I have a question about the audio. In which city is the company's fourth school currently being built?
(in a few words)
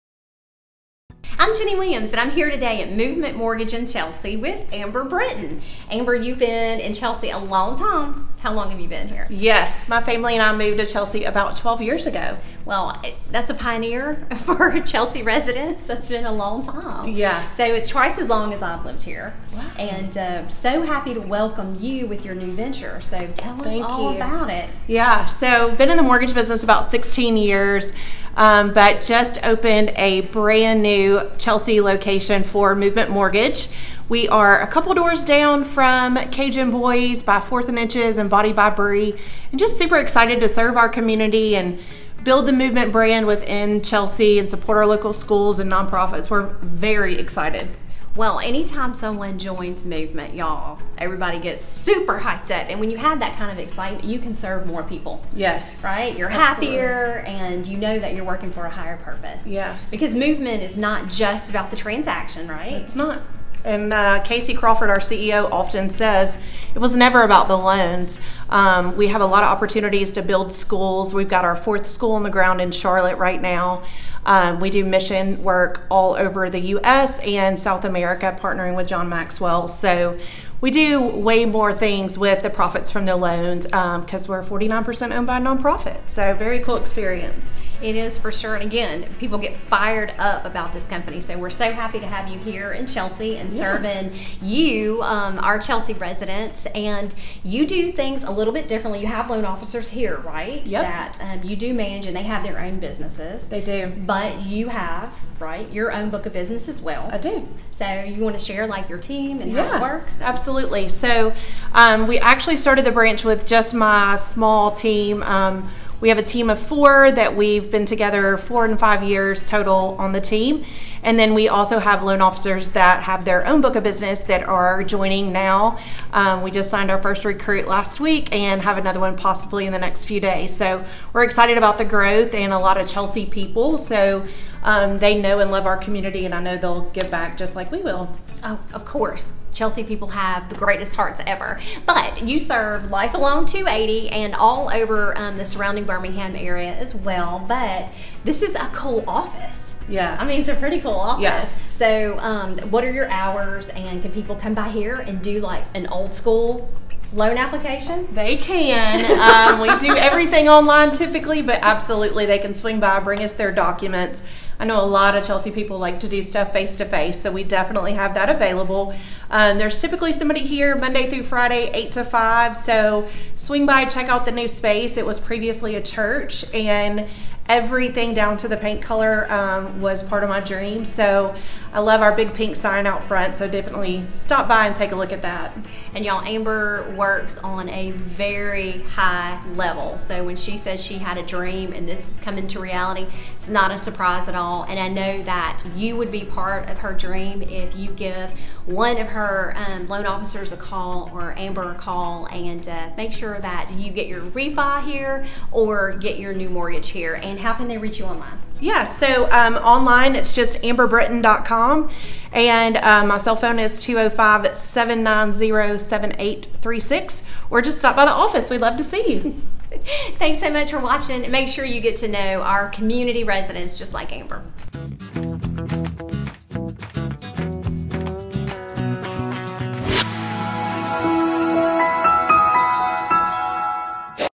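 Charlotte.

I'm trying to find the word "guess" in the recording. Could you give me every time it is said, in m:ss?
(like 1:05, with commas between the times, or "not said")
not said.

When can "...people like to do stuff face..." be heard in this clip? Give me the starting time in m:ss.
2:45.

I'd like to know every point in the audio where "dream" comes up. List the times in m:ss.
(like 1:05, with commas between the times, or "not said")
3:00, 3:11, 3:16.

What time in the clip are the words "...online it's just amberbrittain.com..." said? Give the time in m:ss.
3:29.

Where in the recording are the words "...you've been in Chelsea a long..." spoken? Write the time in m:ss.
0:06.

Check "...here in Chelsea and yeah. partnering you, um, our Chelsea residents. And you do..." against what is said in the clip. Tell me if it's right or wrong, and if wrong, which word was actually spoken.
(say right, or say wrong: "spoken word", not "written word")
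wrong: "serving", not "partnering".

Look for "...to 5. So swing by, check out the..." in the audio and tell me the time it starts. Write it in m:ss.
2:51.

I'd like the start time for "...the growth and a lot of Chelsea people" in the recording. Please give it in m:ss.
2:11.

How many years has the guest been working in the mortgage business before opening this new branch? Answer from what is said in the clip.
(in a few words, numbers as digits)
16.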